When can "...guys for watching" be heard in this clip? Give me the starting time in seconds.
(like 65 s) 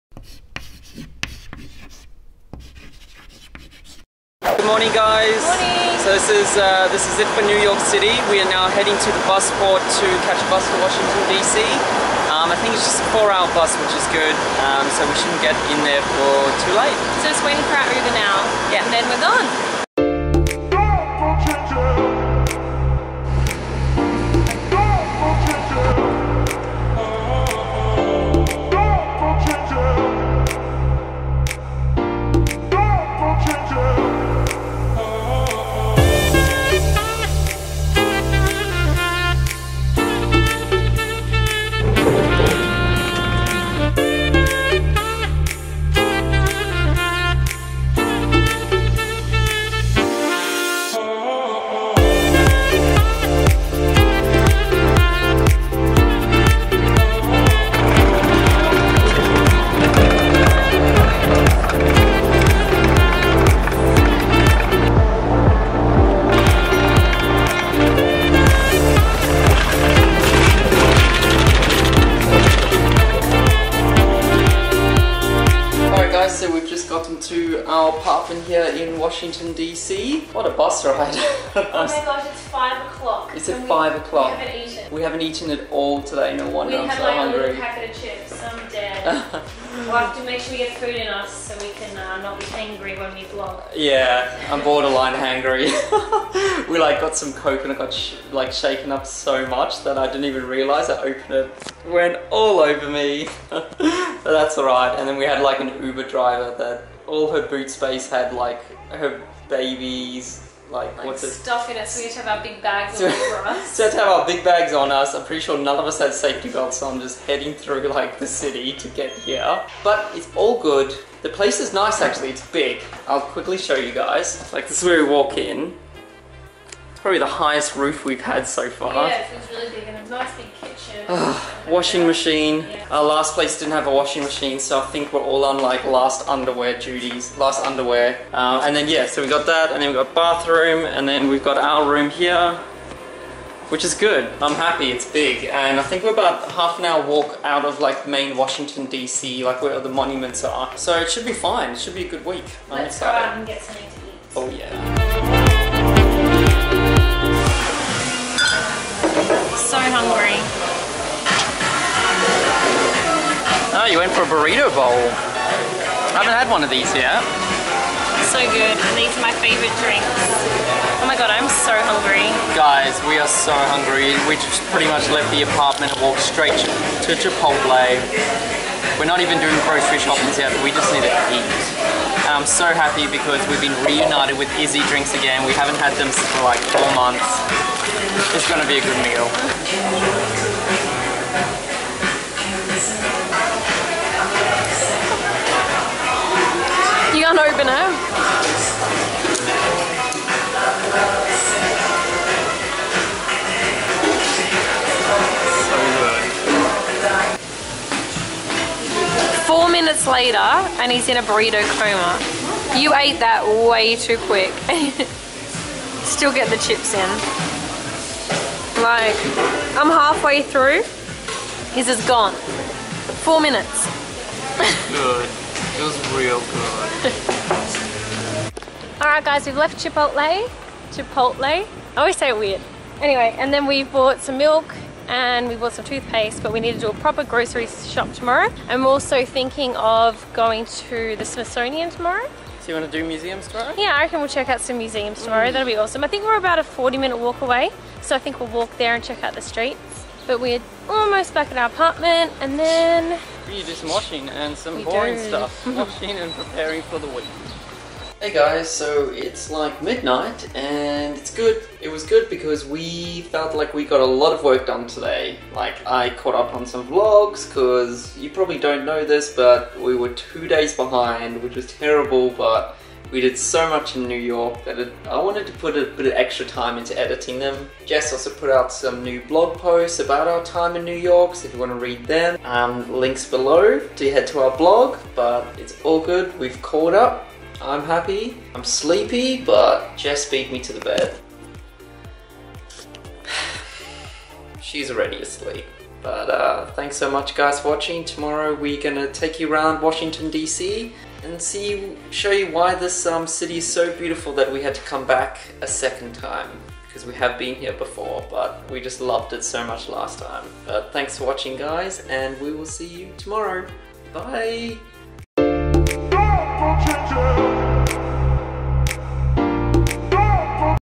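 297 s.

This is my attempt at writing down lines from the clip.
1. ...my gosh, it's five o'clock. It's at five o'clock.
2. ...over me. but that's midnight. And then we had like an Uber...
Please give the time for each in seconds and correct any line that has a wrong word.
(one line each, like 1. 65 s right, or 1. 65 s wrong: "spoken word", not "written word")
1. 81 s right
2. 102 s wrong: "alright", not "midnight".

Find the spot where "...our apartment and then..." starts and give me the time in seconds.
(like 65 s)
251 s.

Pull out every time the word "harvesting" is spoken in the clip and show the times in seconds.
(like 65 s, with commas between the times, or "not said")
not said.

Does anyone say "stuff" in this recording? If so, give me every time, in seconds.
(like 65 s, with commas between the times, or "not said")
111 s, 255 s.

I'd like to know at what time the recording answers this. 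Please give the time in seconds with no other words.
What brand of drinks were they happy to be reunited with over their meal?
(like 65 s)
184 s.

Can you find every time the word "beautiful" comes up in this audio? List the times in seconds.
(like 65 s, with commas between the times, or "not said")
303 s.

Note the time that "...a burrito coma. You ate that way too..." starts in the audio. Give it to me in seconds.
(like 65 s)
211 s.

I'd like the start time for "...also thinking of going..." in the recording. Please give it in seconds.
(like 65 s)
238 s.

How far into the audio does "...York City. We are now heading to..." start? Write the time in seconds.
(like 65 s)
7 s.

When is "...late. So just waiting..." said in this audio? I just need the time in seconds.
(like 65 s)
16 s.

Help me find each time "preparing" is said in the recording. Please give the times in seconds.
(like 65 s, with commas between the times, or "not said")
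256 s.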